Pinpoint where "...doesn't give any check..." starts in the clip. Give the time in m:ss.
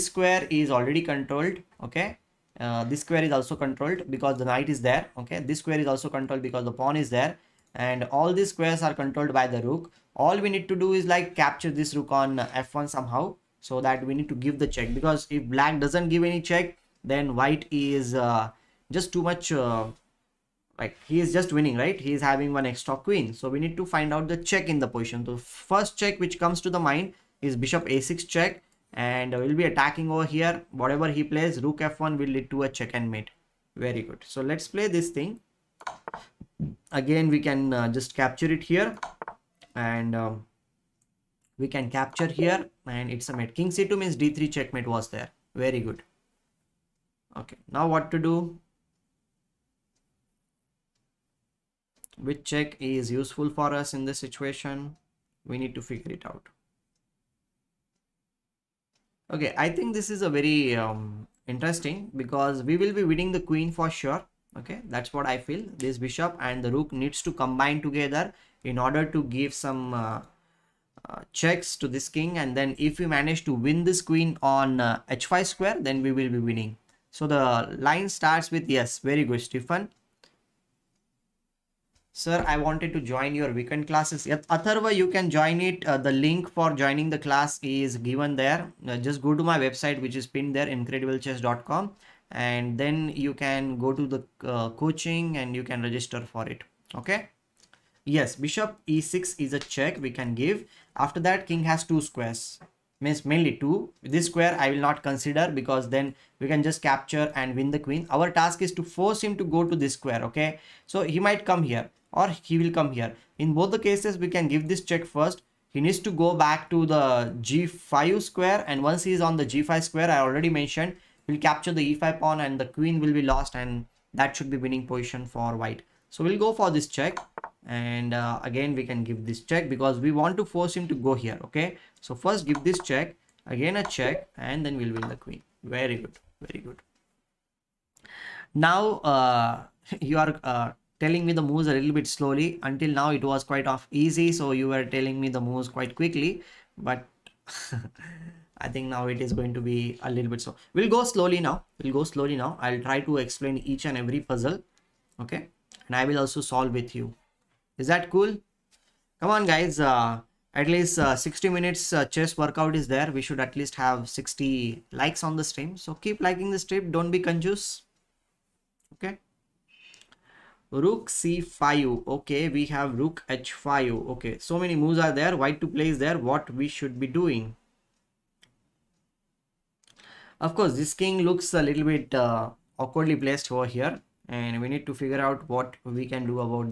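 0:15.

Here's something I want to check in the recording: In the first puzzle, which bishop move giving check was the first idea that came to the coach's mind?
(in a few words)
Bishop a6.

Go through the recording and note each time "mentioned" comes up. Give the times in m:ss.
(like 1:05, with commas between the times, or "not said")
2:00.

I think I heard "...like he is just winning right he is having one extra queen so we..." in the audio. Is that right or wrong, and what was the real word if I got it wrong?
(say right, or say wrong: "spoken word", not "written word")
right.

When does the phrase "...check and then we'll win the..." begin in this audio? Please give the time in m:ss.
2:13.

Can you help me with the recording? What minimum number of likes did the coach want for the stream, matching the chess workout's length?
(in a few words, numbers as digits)
60.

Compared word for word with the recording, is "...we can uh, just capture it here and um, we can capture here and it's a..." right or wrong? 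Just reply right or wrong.
right.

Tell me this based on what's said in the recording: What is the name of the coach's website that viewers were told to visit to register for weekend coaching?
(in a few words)
incrediblechess.com.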